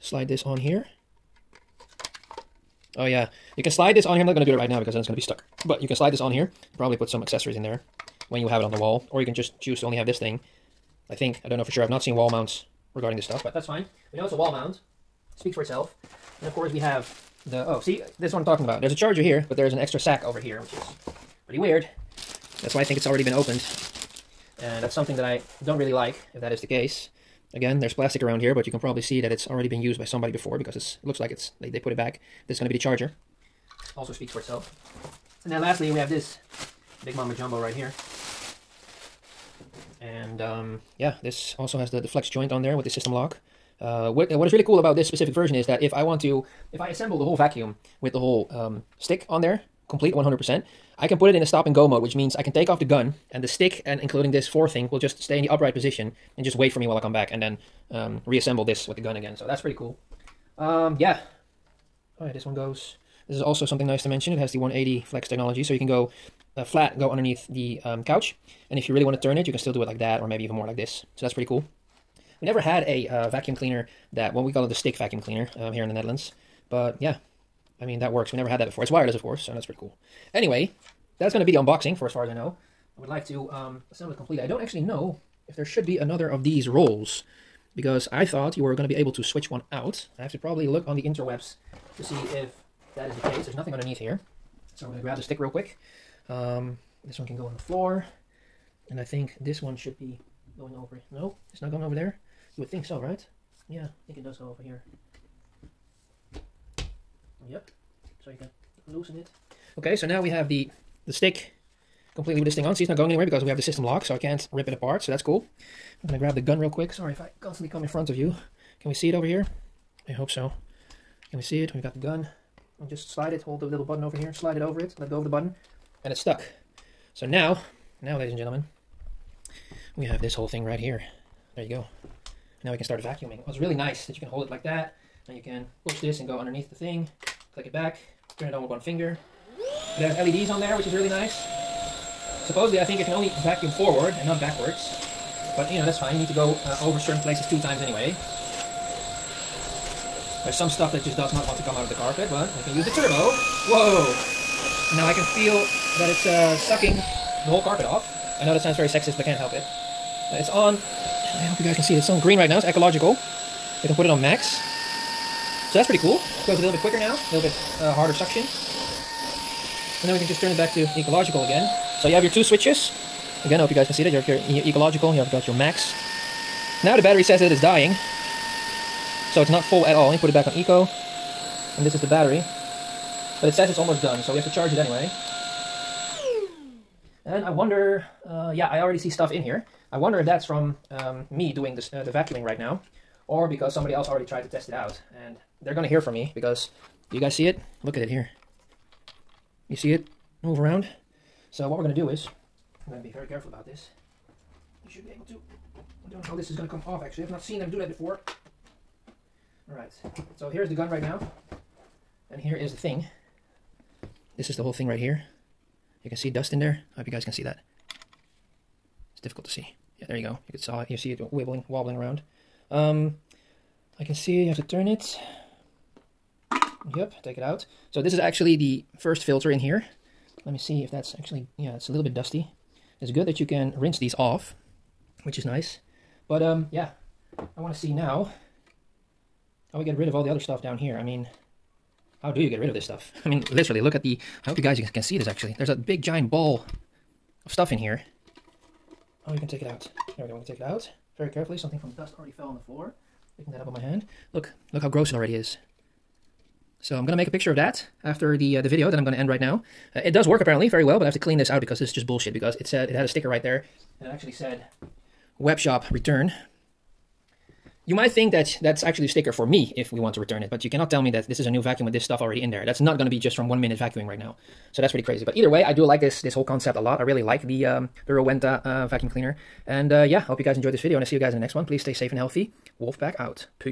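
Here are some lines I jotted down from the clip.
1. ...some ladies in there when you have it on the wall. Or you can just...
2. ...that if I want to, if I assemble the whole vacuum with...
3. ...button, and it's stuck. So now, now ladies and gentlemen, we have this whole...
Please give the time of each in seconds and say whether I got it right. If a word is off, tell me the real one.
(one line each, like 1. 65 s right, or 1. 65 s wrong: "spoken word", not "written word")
1. 7 s wrong: "accessories", not "ladies"
2. 45 s right
3. 125 s right.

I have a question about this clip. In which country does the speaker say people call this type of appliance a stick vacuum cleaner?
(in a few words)
the Netherlands.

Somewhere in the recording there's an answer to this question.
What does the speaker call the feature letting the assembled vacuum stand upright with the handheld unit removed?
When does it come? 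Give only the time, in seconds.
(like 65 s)
51 s.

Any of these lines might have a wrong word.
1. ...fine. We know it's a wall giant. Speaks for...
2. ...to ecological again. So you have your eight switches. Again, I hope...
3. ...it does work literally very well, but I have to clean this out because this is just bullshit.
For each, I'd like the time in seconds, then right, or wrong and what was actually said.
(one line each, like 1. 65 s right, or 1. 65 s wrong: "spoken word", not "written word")
1. 13 s wrong: "mount", not "giant"
2. 170 s wrong: "two", not "eight"
3. 260 s wrong: "apparently", not "literally".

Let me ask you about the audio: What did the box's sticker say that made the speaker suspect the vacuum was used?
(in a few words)
web shop return.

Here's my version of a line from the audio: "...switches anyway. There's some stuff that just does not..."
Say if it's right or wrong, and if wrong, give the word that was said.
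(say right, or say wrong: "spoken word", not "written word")
wrong: "times", not "switches".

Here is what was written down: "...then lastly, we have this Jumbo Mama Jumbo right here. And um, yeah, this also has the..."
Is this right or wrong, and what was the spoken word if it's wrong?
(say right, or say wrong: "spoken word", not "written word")
wrong: "Big", not "Jumbo".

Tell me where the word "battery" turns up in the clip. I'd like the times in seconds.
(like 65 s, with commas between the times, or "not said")
177 s, 182 s.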